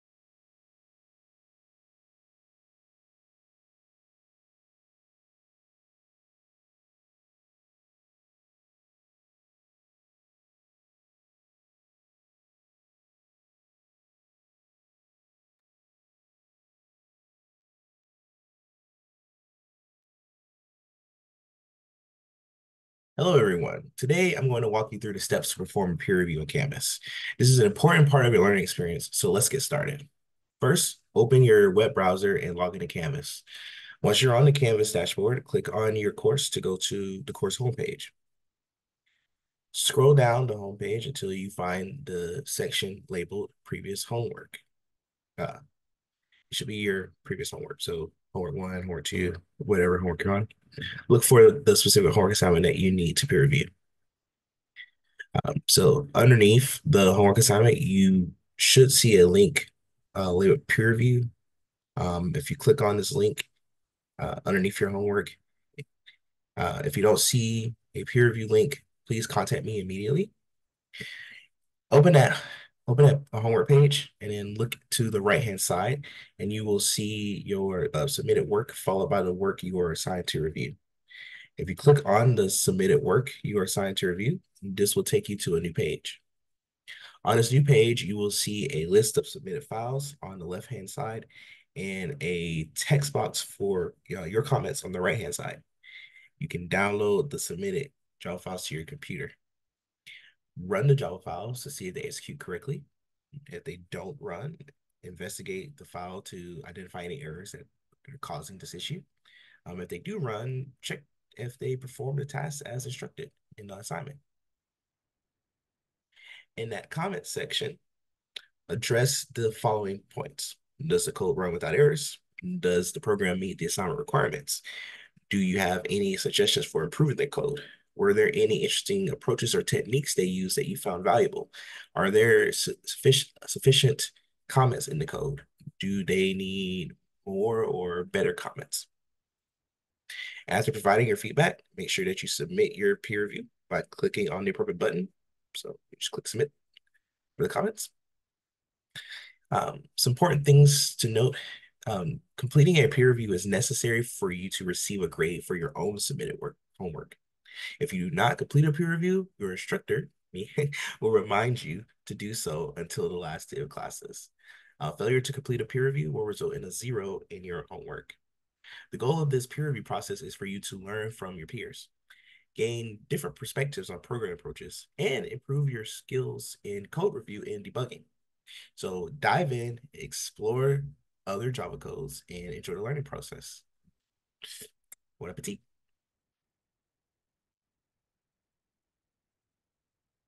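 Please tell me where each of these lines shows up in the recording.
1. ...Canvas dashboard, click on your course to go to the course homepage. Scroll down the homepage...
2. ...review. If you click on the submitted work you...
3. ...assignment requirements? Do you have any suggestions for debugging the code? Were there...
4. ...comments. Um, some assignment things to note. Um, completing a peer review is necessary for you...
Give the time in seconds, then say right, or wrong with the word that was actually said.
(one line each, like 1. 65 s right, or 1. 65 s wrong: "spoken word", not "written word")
1. 34 s right
2. 80 s right
3. 123 s wrong: "improving", not "debugging"
4. 147 s wrong: "important", not "assignment".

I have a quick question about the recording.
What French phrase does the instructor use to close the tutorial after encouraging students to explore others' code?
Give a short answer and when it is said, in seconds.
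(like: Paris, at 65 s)
Bon appetit, at 185 s.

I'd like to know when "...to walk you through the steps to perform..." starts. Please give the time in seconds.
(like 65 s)
24 s.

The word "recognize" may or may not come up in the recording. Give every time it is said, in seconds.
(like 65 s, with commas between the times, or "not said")
not said.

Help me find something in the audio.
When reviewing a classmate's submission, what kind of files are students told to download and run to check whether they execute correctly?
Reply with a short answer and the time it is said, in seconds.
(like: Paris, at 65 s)
Java files, at 100 s.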